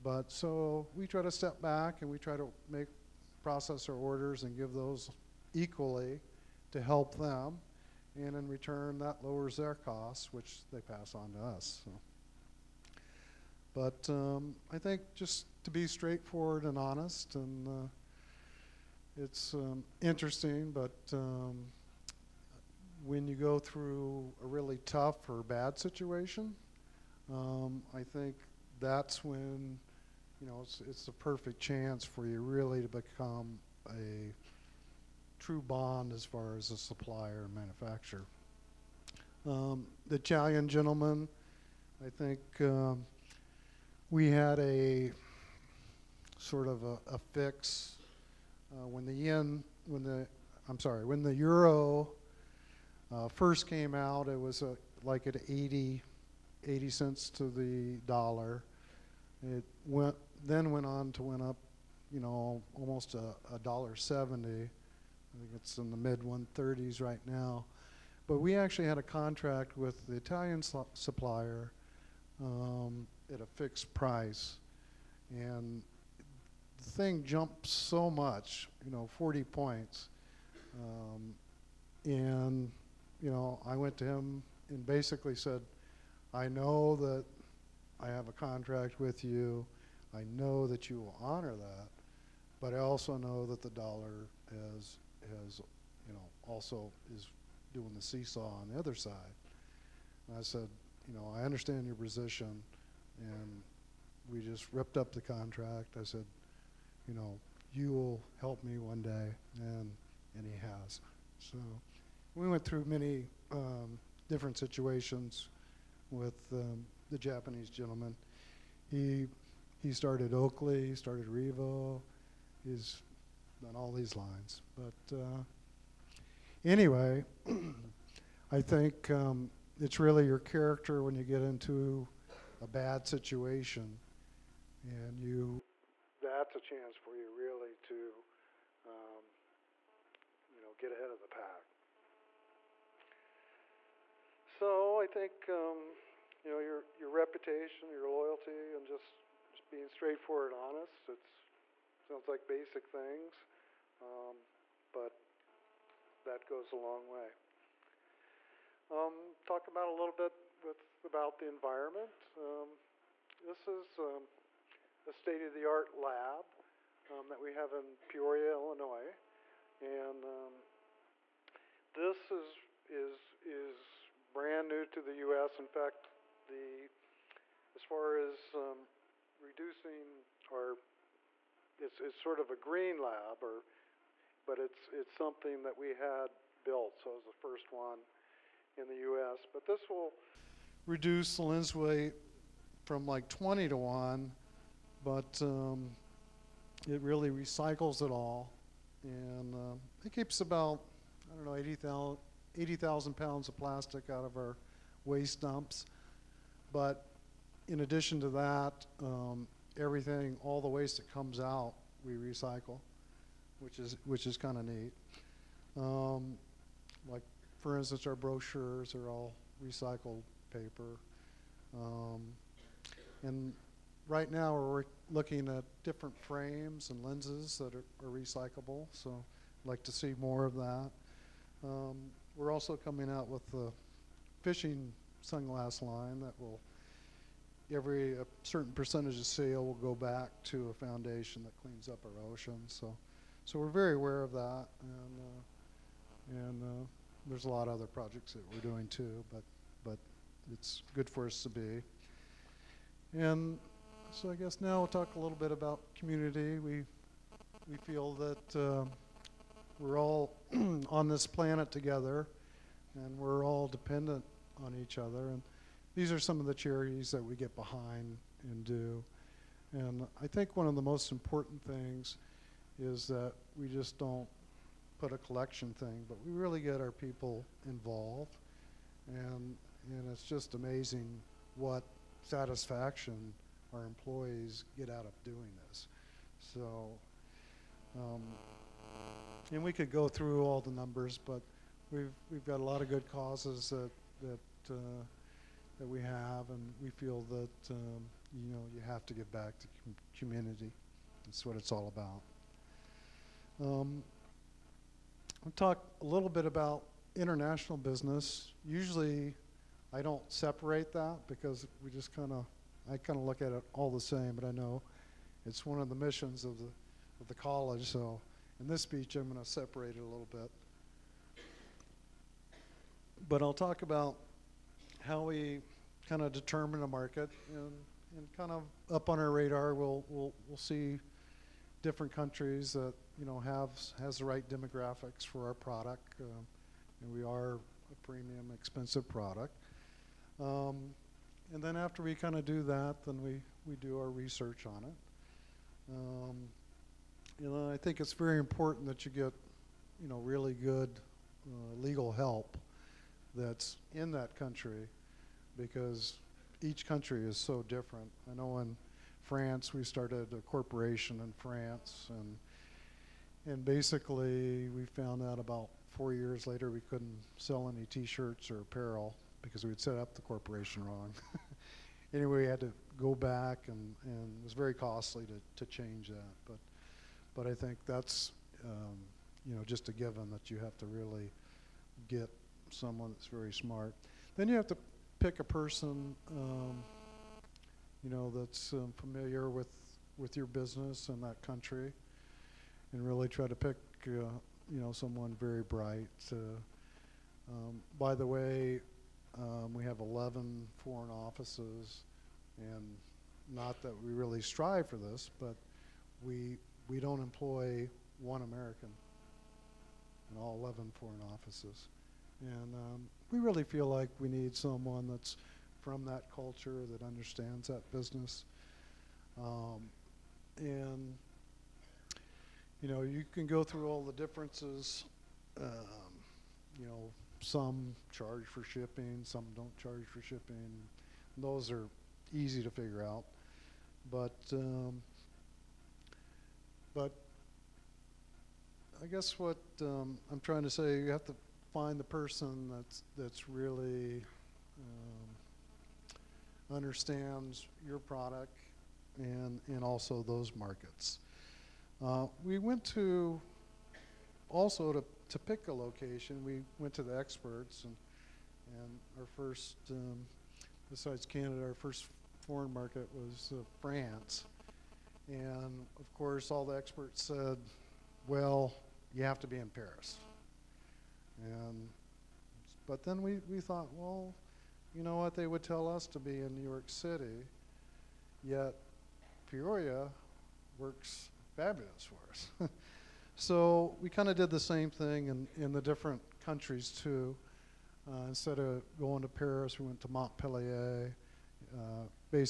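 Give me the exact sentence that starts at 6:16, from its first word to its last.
But, but I think that's, um, you know, just a given that you have to really get someone that's very smart.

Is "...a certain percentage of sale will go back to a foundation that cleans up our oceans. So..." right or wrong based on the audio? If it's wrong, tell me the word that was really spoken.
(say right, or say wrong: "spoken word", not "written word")
right.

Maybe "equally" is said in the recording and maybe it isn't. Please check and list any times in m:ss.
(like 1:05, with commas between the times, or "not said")
0:05.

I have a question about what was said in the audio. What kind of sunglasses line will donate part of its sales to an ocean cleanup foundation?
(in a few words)
fishing.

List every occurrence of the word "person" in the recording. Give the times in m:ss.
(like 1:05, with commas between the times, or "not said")
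6:25, 7:22.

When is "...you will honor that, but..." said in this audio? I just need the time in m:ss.
1:30.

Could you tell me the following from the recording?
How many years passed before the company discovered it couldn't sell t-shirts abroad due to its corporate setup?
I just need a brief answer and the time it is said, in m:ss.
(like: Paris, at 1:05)
4 years, at 6:05.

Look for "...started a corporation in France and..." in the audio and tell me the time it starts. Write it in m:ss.
5:59.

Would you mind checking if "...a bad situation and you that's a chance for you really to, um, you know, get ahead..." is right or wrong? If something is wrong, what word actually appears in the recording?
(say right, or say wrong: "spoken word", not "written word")
right.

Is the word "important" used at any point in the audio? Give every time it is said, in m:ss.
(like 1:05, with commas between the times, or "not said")
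4:31, 5:48.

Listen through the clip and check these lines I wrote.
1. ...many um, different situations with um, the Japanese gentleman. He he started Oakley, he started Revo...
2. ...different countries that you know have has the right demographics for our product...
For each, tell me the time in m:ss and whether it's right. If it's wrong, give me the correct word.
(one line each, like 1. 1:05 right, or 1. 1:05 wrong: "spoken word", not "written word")
1. 1:52 right
2. 5:31 right.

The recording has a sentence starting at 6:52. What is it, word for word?
And um, we really feel like we need someone that's from that culture, that understands that business.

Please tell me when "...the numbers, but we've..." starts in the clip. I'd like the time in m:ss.
4:50.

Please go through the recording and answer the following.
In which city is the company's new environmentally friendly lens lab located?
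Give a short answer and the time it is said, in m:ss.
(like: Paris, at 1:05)
Peoria, Illinois, at 2:48.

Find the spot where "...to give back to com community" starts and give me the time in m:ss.
4:59.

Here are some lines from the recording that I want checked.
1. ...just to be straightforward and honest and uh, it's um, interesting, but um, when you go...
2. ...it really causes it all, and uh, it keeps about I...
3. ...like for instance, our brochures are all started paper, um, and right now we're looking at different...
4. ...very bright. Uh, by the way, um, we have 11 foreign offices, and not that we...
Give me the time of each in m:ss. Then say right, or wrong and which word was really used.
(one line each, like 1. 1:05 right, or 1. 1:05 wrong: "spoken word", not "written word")
1. 0:15 right
2. 3:16 wrong: "recycles", not "causes"
3. 3:37 wrong: "recycled", not "started"
4. 6:35 right.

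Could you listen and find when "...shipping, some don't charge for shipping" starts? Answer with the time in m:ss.
7:08.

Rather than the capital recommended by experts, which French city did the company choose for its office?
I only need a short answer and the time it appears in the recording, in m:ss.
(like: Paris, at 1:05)
Montpellier, at 8:10.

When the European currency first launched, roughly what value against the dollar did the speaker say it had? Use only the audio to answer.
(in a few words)
80 cents.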